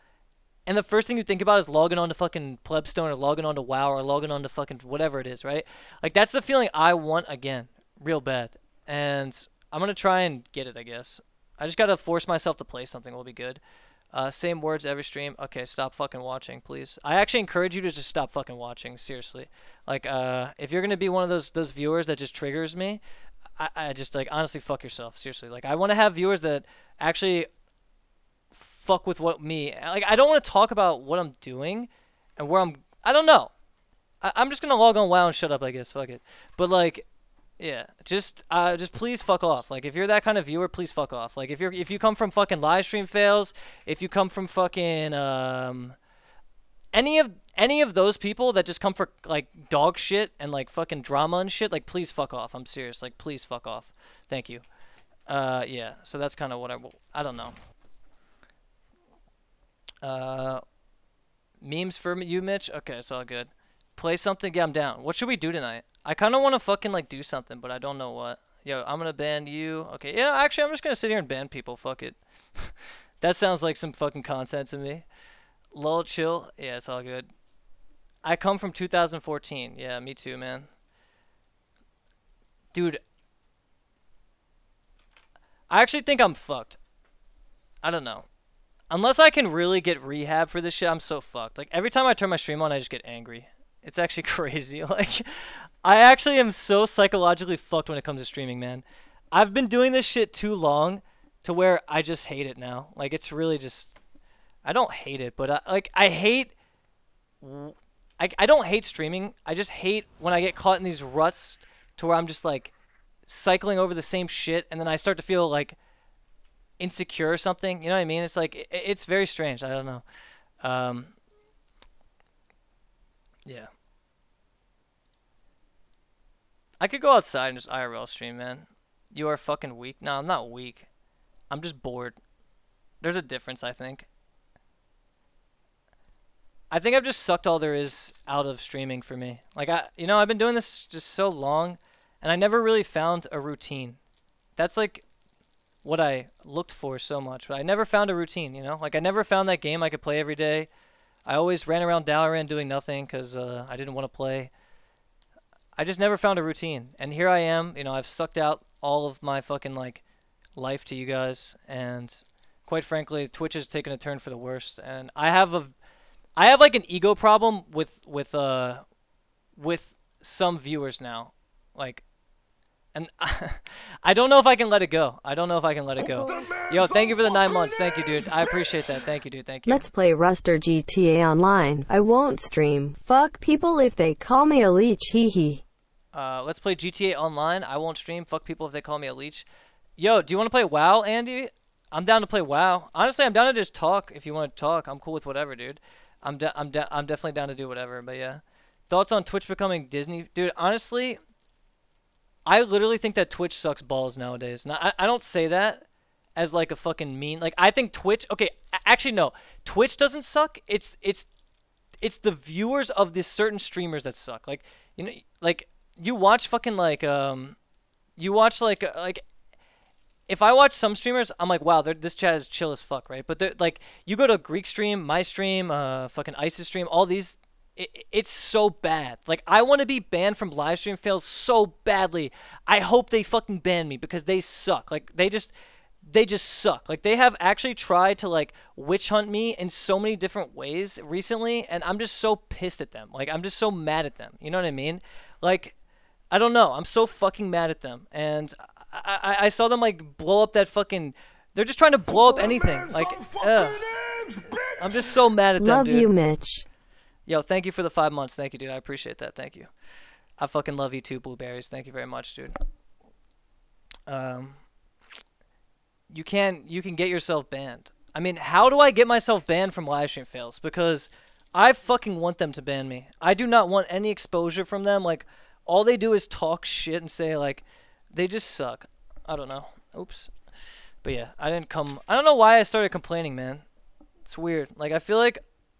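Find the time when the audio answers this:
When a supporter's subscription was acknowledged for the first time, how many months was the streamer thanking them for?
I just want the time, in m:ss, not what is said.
2:57.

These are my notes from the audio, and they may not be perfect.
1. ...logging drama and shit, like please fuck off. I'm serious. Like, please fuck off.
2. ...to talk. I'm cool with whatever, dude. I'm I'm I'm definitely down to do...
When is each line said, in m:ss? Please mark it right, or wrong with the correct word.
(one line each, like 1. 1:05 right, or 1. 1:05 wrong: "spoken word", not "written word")
1. 0:50 wrong: "fucking", not "logging"
2. 3:14 right.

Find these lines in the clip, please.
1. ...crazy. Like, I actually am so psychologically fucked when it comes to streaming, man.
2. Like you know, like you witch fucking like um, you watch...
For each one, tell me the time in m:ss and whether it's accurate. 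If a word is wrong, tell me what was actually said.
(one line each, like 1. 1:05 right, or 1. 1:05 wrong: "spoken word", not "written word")
1. 1:34 right
2. 3:34 wrong: "watch", not "witch".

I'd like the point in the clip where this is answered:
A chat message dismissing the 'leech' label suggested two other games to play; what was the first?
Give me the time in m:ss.
3:00.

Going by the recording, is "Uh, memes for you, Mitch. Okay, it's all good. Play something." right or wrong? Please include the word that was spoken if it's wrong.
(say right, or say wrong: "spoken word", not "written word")
right.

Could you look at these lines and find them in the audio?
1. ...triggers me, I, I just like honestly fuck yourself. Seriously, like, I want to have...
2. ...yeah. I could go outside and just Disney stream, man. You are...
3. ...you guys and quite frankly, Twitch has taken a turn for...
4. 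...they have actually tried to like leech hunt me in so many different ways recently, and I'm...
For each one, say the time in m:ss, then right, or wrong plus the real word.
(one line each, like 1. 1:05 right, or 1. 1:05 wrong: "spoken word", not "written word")
1. 0:22 right
2. 2:03 wrong: "IRL", not "Disney"
3. 2:40 right
4. 3:57 wrong: "witch", not "leech".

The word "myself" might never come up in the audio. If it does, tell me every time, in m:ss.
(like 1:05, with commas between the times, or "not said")
0:12, 4:29.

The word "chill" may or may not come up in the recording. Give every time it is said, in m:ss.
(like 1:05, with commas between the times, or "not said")
1:16, 3:42.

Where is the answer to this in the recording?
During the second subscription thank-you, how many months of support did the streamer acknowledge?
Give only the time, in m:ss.
4:17.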